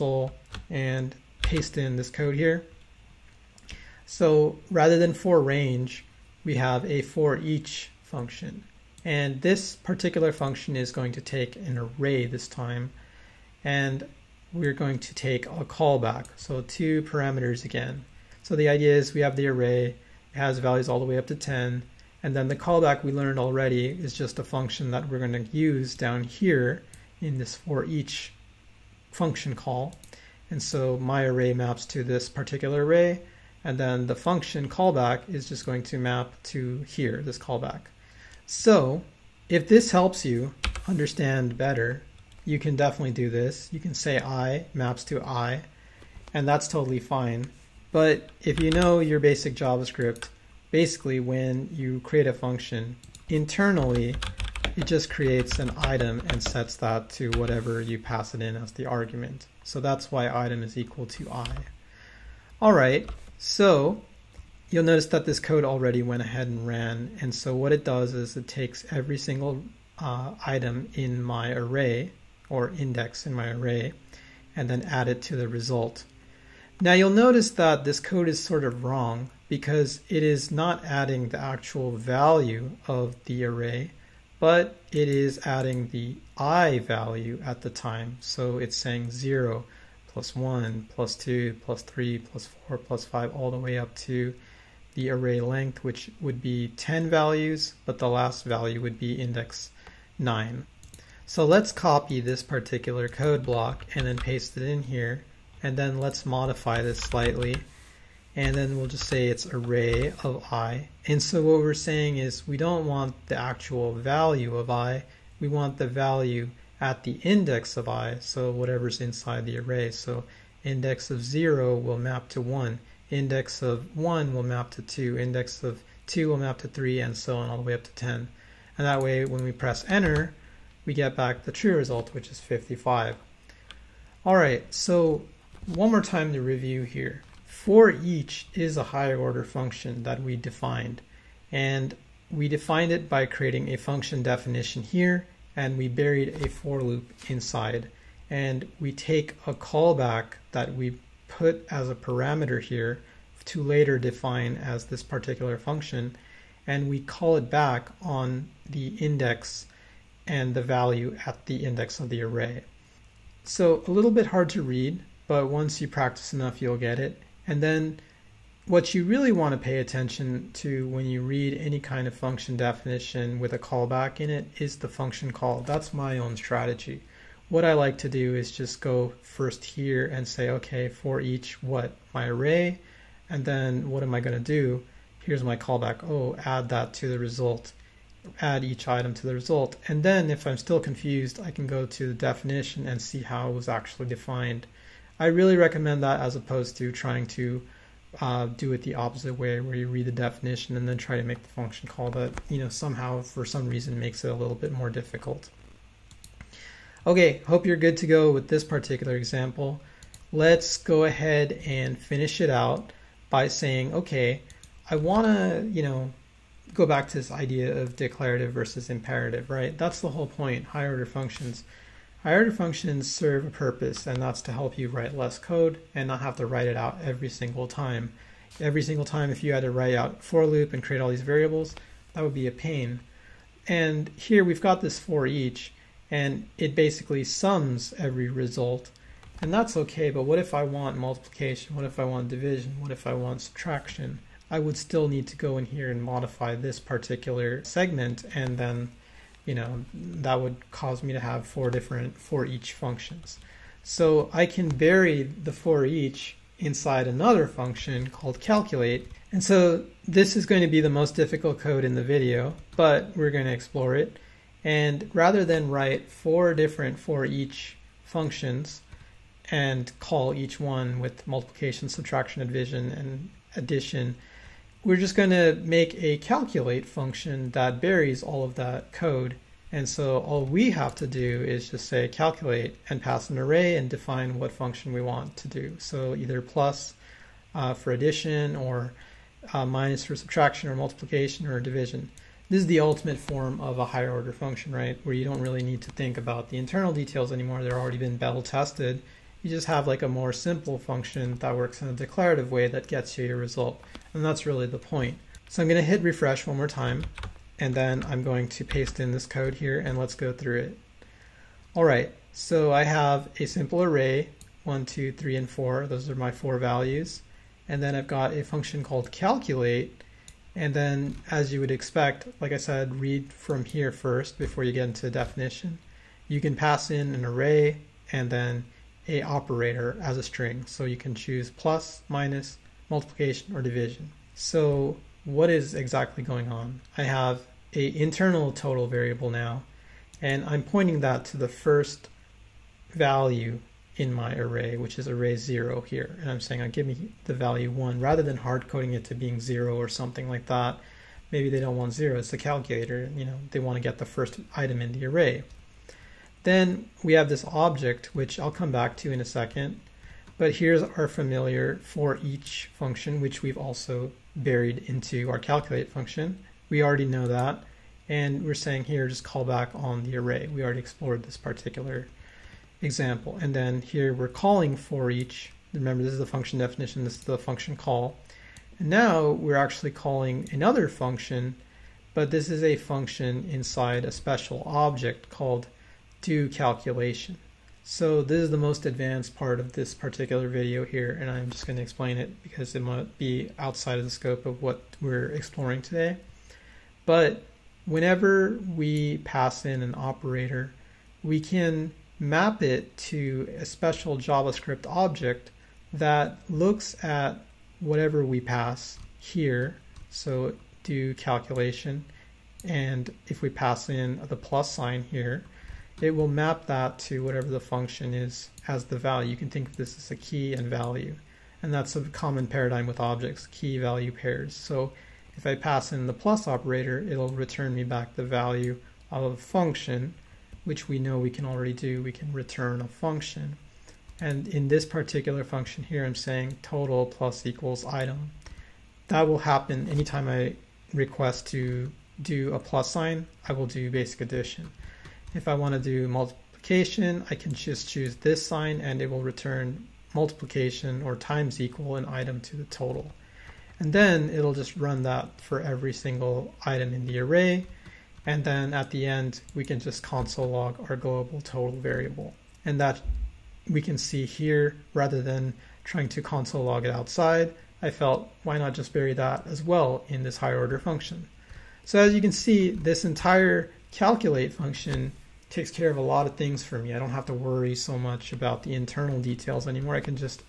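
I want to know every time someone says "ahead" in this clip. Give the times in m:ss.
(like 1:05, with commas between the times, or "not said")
1:06, 3:31.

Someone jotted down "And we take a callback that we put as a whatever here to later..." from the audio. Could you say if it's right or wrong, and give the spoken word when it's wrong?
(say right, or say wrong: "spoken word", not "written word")
wrong: "parameter", not "whatever".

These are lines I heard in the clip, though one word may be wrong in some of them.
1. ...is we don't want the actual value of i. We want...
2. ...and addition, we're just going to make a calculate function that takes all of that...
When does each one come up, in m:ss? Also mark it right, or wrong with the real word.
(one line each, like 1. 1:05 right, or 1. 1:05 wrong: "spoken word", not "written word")
1. 1:52 right
2. 4:32 wrong: "buries", not "takes".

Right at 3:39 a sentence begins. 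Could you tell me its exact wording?
That's the whole point, higher order functions.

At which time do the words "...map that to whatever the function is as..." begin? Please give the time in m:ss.
6:56.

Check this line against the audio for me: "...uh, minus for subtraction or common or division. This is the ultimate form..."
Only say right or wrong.
wrong.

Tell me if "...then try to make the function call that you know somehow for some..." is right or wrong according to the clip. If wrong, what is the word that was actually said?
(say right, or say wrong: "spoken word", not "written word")
right.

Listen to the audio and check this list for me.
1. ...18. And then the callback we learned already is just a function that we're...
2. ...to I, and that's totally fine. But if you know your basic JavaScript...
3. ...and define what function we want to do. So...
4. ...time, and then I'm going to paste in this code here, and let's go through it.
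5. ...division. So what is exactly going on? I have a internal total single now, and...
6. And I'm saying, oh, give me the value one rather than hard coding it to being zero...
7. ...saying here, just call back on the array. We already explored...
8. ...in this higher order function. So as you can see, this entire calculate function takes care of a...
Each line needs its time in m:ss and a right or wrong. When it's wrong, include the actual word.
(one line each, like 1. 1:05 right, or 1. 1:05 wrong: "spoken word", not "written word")
1. 0:21 wrong: "10", not "18"
2. 0:45 right
3. 4:43 right
4. 5:06 right
5. 5:33 wrong: "variable", not "single"
6. 5:46 right
7. 6:08 right
8. 7:50 right.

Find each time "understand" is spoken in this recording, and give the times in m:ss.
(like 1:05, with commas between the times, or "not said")
0:40.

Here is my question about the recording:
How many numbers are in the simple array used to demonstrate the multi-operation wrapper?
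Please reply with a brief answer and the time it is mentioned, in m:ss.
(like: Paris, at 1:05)
4, at 5:16.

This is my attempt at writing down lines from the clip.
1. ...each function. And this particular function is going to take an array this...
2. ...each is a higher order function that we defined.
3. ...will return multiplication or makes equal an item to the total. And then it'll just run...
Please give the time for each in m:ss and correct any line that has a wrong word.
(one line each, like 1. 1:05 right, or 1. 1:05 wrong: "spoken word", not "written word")
1. 0:07 right
2. 2:17 right
3. 7:29 wrong: "times", not "makes".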